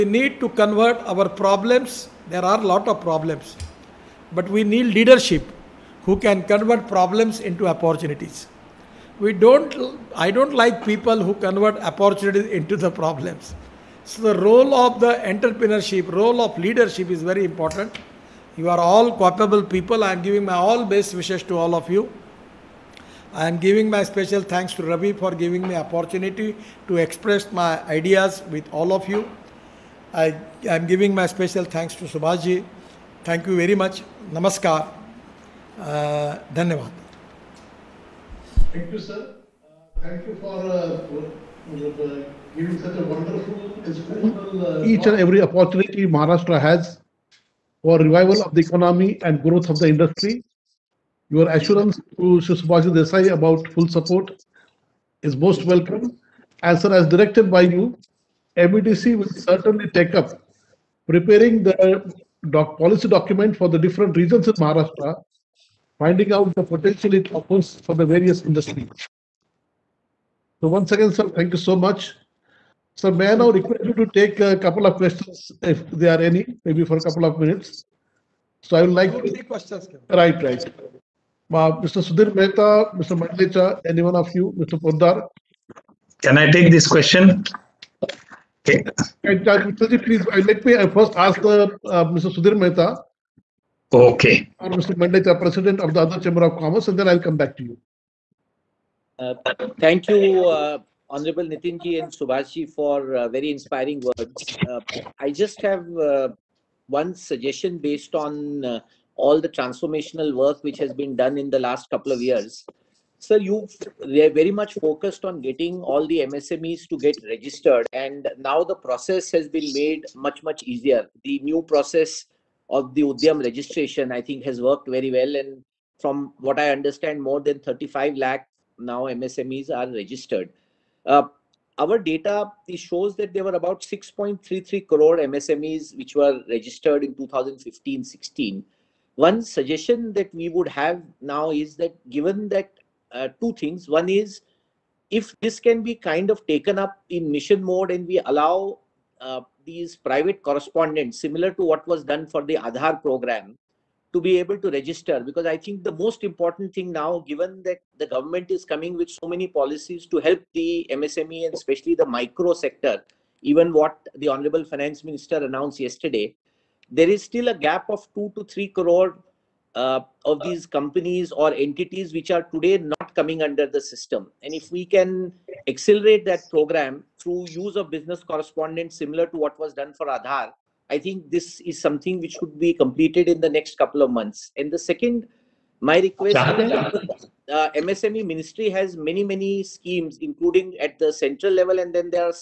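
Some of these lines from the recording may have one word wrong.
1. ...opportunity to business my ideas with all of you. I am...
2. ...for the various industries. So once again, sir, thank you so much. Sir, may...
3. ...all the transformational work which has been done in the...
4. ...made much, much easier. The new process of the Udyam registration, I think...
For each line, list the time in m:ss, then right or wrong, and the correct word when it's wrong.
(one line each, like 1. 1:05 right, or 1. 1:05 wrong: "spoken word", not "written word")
1. 0:25 wrong: "express", not "business"
2. 1:07 right
3. 1:49 right
4. 1:59 right.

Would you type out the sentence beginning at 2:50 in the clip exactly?
these companies or entities which are today not coming under the system.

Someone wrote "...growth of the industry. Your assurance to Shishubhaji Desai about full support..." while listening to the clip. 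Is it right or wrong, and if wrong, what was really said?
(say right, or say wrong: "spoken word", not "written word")
right.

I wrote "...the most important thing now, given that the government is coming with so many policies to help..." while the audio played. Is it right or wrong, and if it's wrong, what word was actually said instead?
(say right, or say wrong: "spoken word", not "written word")
right.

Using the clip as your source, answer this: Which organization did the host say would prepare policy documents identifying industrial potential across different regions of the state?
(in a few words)
MEDC.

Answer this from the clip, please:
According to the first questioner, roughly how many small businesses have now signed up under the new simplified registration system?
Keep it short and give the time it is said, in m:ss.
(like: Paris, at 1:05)
35 lakh, at 2:07.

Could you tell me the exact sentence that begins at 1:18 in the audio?
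So I would like to take questions.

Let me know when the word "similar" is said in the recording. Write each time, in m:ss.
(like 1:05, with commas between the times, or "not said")
2:31, 2:59.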